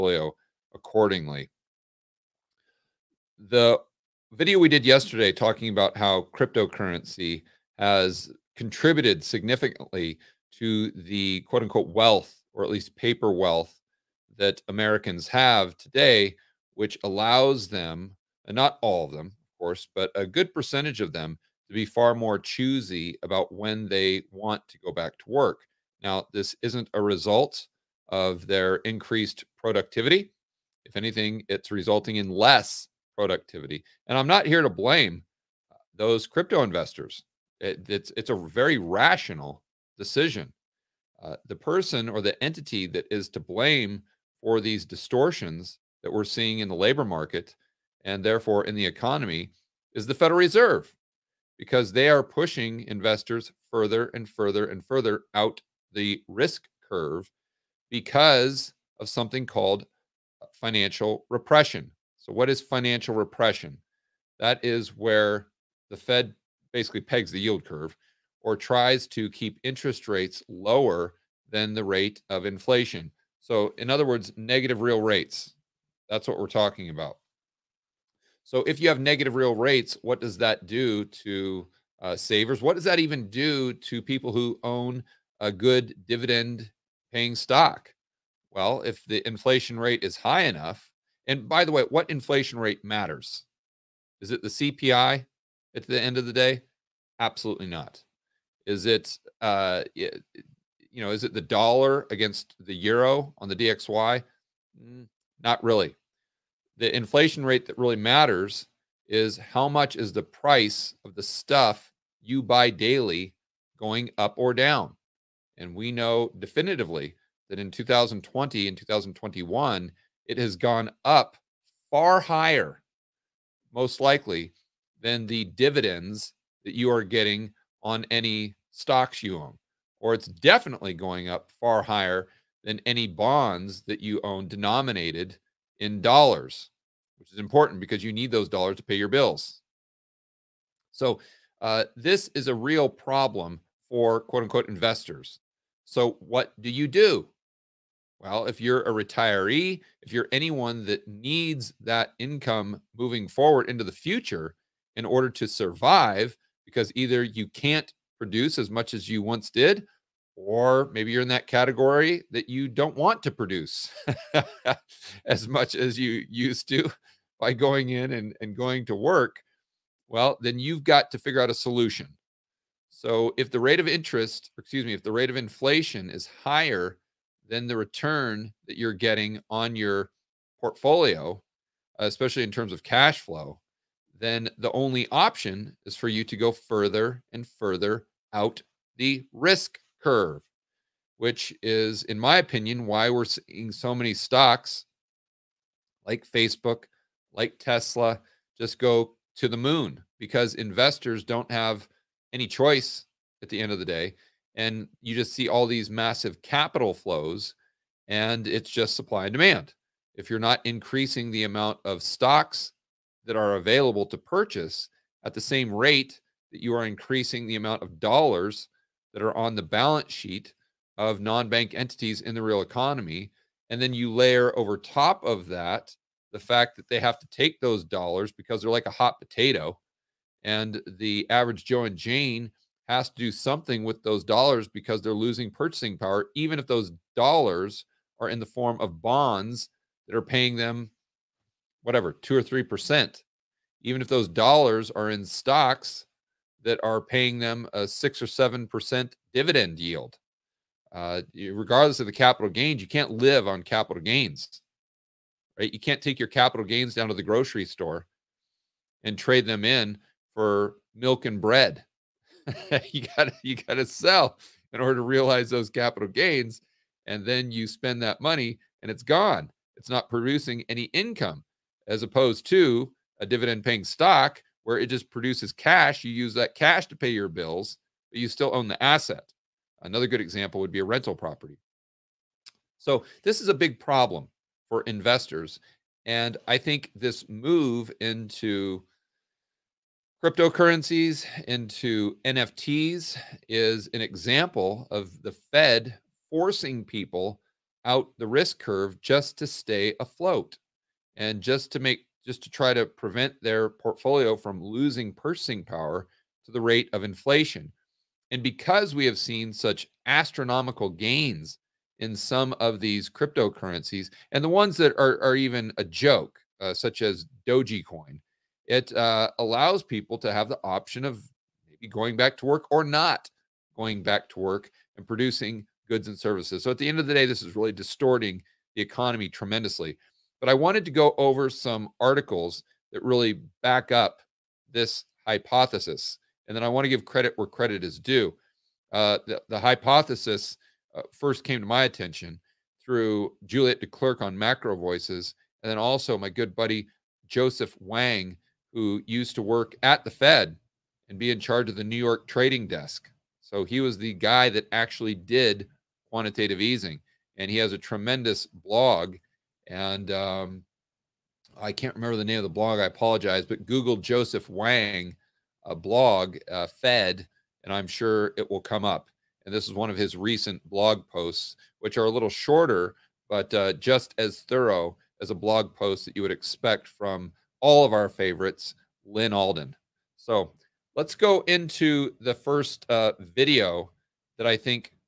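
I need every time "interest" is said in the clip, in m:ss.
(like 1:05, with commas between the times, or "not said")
1:09, 2:53.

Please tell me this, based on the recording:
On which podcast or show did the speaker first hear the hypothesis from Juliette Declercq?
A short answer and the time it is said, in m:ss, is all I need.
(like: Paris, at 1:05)
Macro Voices, at 5:44.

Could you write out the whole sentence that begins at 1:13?
So, in other words, negative real rates.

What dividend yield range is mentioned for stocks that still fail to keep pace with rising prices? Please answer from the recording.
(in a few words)
6 or 7%.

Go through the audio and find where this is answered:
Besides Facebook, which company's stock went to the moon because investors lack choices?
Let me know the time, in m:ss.
3:17.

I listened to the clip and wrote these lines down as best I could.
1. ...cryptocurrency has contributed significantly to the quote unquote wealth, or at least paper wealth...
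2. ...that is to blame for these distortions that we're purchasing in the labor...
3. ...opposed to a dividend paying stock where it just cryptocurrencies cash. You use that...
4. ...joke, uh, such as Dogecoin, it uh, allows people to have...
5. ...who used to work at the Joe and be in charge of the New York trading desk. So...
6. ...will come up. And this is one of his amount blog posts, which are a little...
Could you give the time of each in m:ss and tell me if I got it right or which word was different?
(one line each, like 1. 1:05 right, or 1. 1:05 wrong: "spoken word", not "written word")
1. 0:06 right
2. 0:42 wrong: "seeing", not "purchasing"
3. 4:32 wrong: "produces", not "cryptocurrencies"
4. 5:15 right
5. 5:48 wrong: "Fed", not "Joe"
6. 6:08 wrong: "recent", not "amount".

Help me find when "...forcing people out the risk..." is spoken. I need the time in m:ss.
4:56.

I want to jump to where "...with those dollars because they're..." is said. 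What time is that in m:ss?
3:53.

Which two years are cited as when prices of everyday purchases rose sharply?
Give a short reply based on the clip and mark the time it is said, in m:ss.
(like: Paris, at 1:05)
2020 and 2021, at 1:57.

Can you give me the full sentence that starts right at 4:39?
Another good example would be a rental property.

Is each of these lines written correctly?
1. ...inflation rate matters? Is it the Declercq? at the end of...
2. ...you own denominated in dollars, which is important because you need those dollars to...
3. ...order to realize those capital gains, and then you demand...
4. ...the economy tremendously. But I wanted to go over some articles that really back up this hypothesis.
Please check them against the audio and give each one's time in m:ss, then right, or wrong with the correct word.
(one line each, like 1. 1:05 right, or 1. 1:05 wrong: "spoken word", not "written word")
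1. 1:32 wrong: "CPI", not "Declercq"
2. 2:14 right
3. 4:24 wrong: "spend", not "demand"
4. 5:28 right.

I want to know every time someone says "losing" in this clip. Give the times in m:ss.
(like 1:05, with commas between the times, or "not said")
3:55, 5:04.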